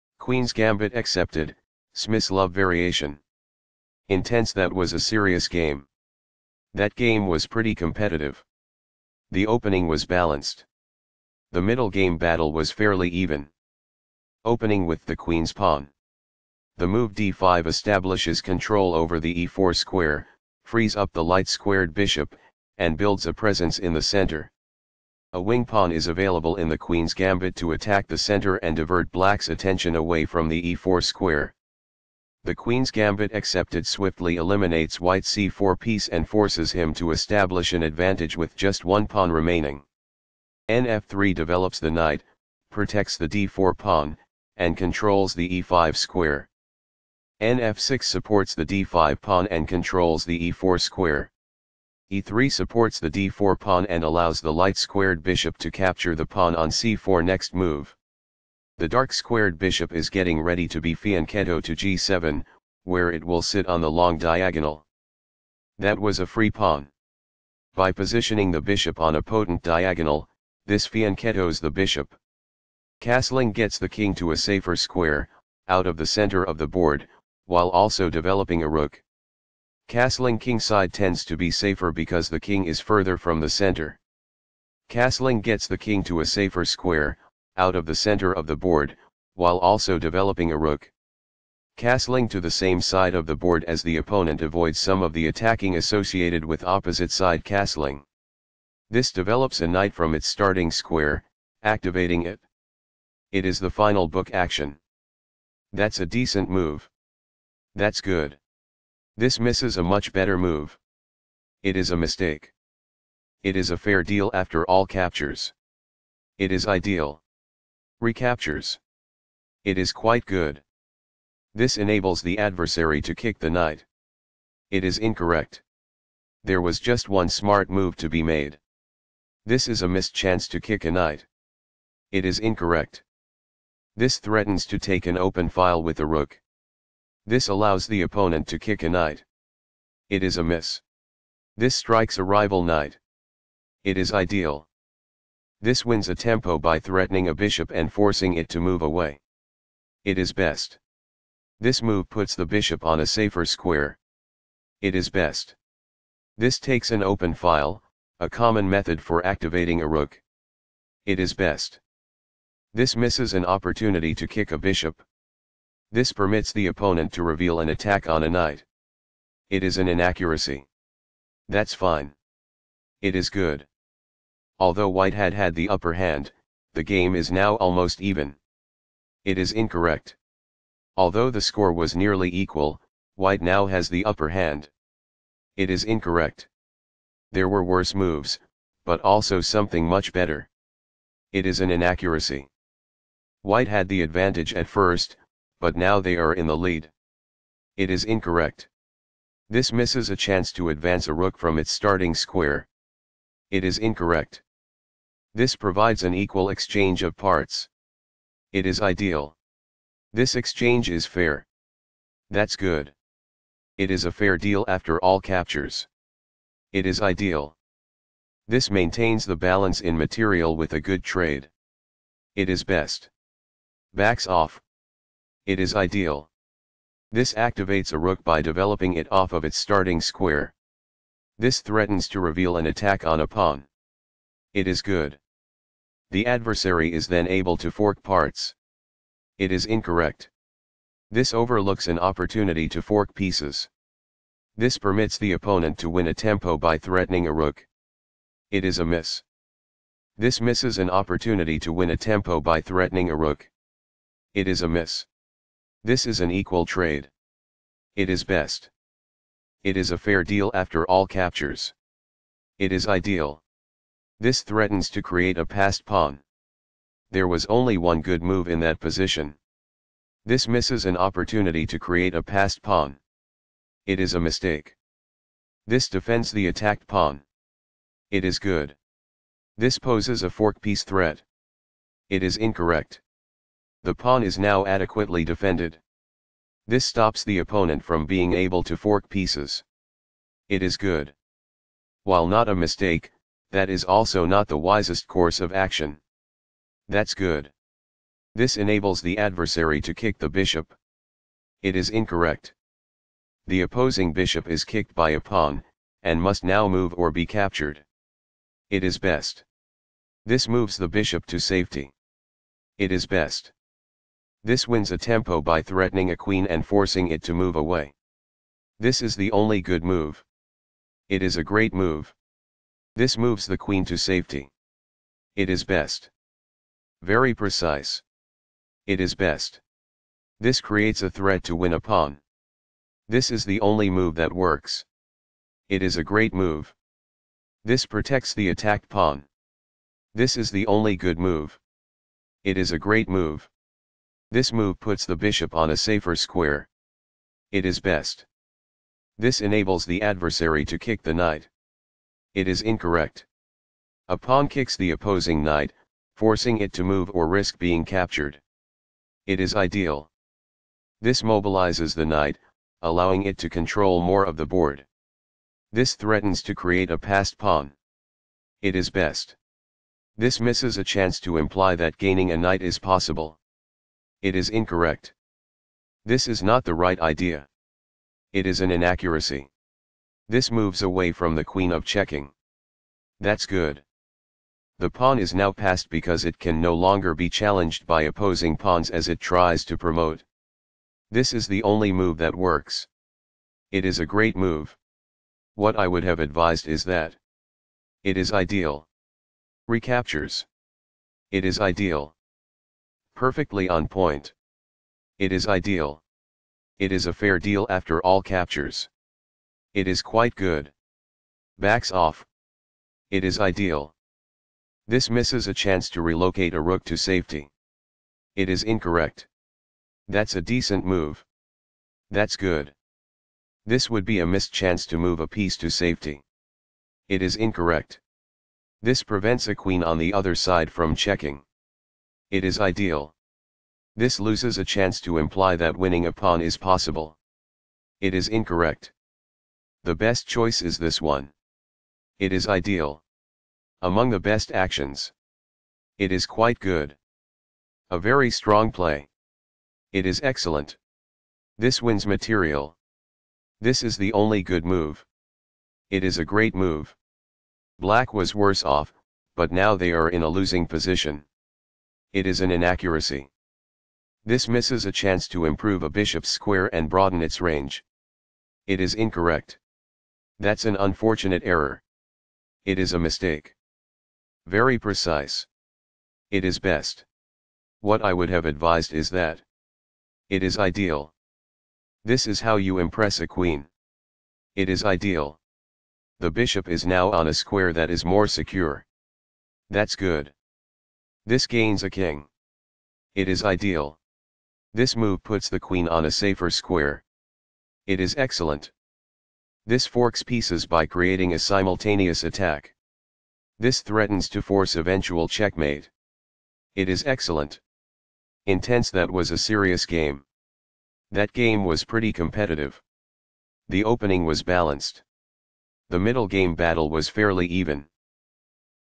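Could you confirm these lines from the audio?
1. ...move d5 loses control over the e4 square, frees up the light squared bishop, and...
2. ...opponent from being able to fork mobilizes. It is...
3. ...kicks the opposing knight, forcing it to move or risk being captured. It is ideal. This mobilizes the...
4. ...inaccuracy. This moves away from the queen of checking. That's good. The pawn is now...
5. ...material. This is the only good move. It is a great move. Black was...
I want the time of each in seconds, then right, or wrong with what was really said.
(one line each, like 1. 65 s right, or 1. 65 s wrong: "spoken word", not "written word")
1. 16 s wrong: "establishes", not "loses"
2. 287 s wrong: "pieces", not "mobilizes"
3. 354 s right
4. 378 s right
5. 452 s right.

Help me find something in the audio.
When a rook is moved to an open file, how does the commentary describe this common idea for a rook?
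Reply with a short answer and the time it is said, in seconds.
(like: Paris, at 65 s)
Activating a rook, at 159 s.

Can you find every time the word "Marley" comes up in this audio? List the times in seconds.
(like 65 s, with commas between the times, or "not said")
not said.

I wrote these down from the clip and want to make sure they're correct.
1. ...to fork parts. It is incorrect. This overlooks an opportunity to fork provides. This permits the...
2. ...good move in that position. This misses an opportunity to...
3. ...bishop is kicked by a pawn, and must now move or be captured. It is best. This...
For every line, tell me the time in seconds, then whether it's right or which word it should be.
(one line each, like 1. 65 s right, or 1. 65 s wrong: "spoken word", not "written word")
1. 237 s wrong: "pieces", not "provides"
2. 268 s right
3. 304 s right.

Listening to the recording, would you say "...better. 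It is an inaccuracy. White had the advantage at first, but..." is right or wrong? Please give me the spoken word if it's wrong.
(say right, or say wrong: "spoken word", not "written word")
right.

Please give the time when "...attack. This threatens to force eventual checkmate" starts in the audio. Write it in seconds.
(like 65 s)
502 s.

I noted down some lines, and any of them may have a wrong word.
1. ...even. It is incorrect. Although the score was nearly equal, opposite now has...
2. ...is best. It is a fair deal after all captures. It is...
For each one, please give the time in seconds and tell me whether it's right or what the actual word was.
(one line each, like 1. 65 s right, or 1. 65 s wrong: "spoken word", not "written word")
1. 177 s wrong: "white", not "opposite"
2. 258 s right.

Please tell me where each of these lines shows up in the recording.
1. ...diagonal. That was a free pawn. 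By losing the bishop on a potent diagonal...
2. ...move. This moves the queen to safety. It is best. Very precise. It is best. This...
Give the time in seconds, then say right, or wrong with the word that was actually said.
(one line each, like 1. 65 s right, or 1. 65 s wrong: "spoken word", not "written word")
1. 64 s wrong: "positioning", not "losing"
2. 321 s right.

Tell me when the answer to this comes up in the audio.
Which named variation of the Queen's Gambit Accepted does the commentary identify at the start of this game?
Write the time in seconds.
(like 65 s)
1 s.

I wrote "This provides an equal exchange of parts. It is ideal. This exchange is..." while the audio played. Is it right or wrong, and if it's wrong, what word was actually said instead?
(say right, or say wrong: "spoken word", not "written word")
right.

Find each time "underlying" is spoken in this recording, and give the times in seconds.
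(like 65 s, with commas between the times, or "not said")
not said.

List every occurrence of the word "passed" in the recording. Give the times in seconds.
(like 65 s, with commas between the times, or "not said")
265 s, 272 s, 366 s, 385 s.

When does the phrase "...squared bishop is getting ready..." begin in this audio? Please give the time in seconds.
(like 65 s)
59 s.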